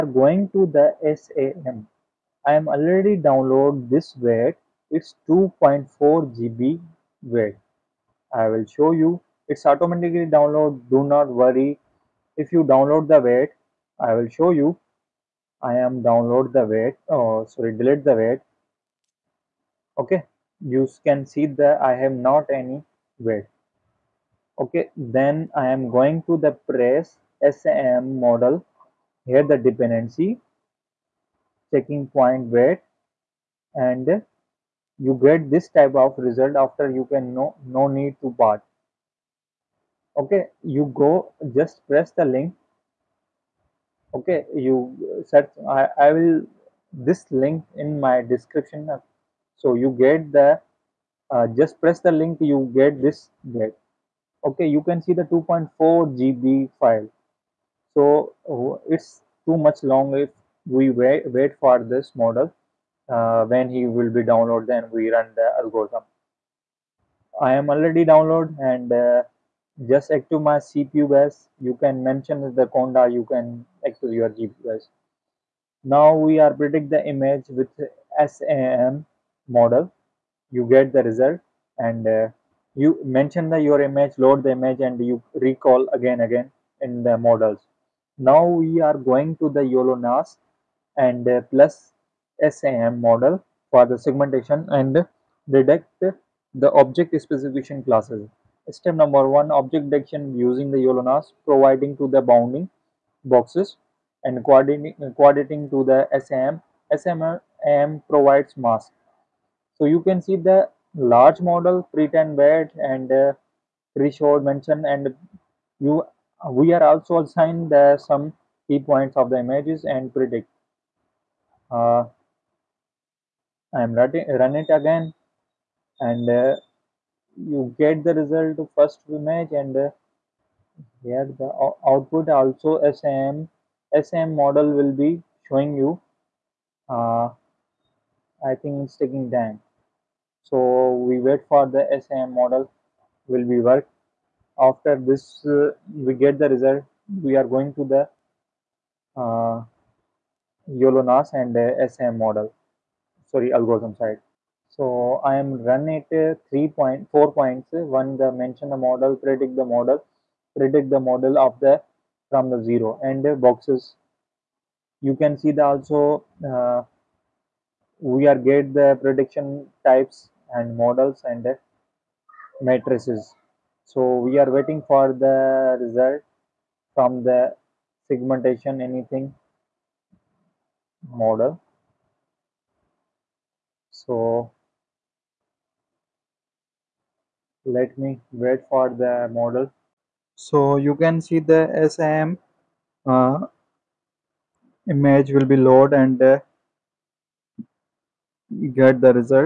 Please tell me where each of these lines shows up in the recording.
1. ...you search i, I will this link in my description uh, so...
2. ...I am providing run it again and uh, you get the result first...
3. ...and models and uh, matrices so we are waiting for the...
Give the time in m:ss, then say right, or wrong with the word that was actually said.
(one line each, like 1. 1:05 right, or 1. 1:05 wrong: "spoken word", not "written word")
1. 0:44 right
2. 2:03 wrong: "running", not "providing"
3. 2:50 right.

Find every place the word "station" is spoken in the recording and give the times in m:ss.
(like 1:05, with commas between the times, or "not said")
not said.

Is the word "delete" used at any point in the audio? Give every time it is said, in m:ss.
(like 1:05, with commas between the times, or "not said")
0:17.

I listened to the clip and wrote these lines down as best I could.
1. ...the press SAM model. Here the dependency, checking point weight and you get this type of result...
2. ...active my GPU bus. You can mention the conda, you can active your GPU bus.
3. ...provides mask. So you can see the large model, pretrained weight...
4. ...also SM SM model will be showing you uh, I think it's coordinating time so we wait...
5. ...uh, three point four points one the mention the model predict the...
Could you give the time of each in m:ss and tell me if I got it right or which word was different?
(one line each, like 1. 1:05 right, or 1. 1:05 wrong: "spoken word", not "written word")
1. 0:26 right
2. 1:10 wrong: "CPU", not "GPU"
3. 1:48 right
4. 2:12 wrong: "taking", not "coordinating"
5. 2:36 right.